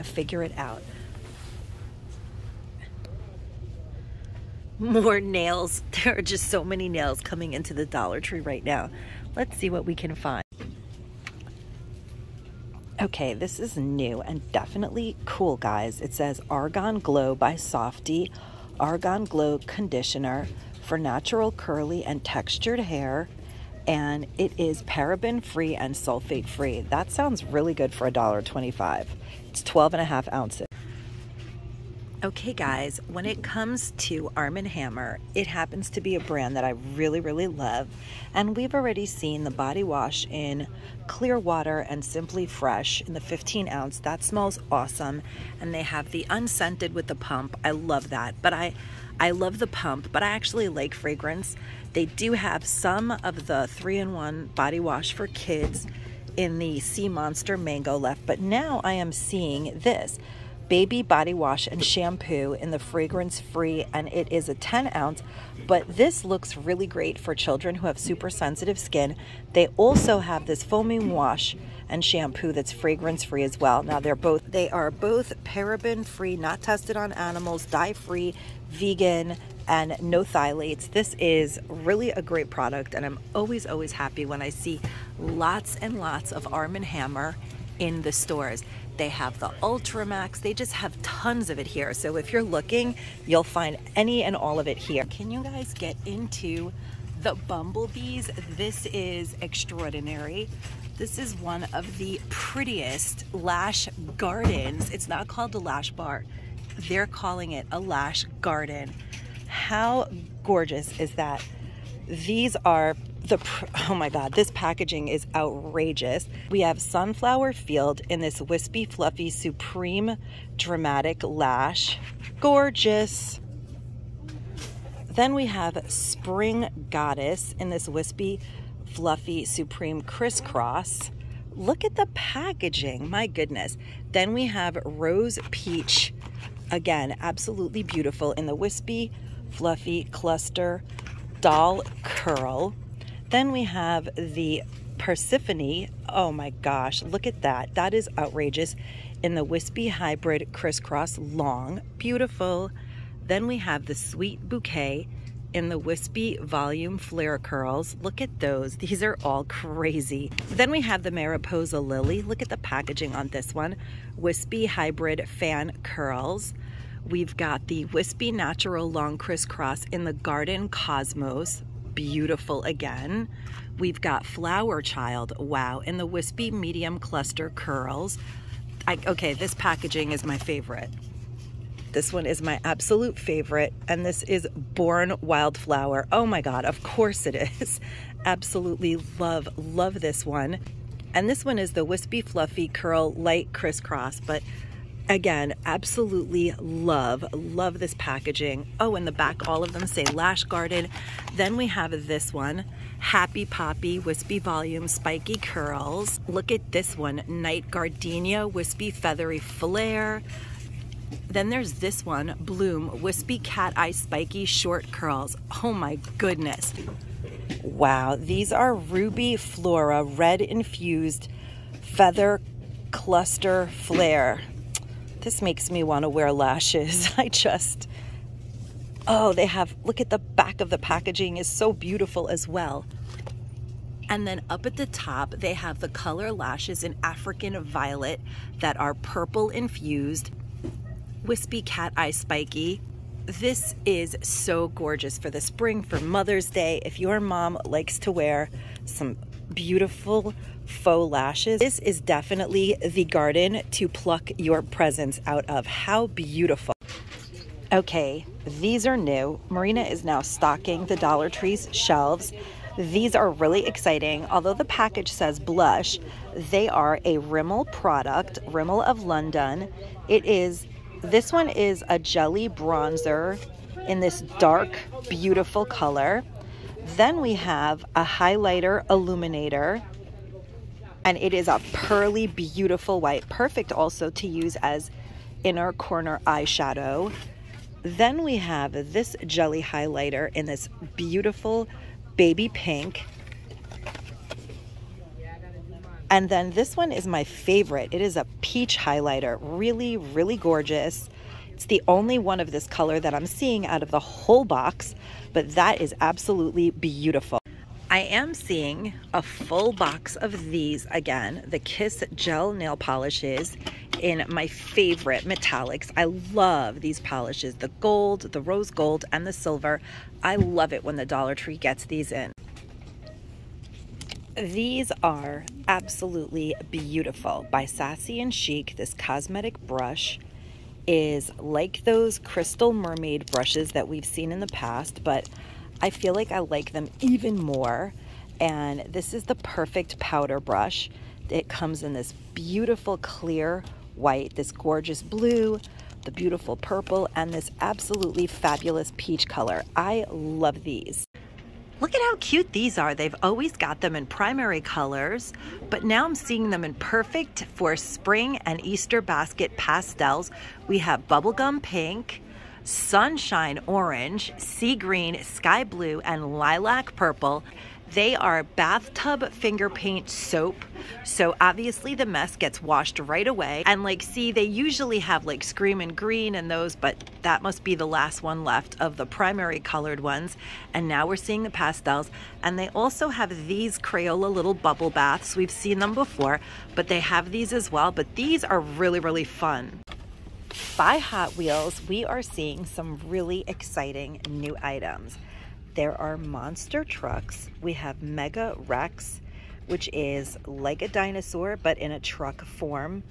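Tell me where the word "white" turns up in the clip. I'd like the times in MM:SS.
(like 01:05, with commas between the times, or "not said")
04:43, 05:43.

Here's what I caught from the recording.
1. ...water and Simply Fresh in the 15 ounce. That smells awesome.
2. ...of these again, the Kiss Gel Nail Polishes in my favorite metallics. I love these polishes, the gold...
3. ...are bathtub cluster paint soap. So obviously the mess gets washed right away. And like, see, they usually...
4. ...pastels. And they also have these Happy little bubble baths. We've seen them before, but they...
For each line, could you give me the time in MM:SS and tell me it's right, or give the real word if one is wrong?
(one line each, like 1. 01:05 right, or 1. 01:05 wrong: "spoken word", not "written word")
1. 00:41 right
2. 05:10 right
3. 06:08 wrong: "finger", not "cluster"
4. 06:21 wrong: "Crayola", not "Happy".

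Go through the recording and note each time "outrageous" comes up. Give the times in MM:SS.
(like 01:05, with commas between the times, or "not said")
01:55, 02:28.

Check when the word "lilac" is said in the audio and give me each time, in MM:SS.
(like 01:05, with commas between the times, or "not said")
06:06.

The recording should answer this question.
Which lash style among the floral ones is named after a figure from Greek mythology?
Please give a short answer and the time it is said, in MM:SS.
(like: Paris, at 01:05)
Persephone, at 02:24.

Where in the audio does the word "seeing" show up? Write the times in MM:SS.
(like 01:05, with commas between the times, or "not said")
00:59, 05:03, 05:08, 05:56, 06:21, 06:32.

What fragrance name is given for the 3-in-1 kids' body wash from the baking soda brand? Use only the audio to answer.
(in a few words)
Sea Monster Mango.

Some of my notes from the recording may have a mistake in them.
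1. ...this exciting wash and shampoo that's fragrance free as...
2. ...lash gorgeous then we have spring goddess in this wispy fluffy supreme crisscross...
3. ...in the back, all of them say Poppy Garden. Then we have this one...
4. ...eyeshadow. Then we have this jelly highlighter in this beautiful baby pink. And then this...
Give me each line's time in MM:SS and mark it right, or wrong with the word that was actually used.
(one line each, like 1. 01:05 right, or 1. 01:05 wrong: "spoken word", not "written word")
1. 01:10 wrong: "foaming", not "exciting"
2. 02:01 right
3. 03:18 wrong: "Lash", not "Poppy"
4. 04:46 right.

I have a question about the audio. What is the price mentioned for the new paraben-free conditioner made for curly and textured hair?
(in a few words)
$1.25.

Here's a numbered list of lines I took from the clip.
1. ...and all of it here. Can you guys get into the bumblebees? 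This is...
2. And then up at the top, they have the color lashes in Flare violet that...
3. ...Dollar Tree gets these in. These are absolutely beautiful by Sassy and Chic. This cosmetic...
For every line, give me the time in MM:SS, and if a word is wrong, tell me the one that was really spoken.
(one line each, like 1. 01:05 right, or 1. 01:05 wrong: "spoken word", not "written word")
1. 01:34 right
2. 03:54 wrong: "African", not "Flare"
3. 05:21 right.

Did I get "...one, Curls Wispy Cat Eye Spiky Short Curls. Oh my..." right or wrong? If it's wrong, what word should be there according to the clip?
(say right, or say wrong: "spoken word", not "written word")
wrong: "Bloom", not "Curls".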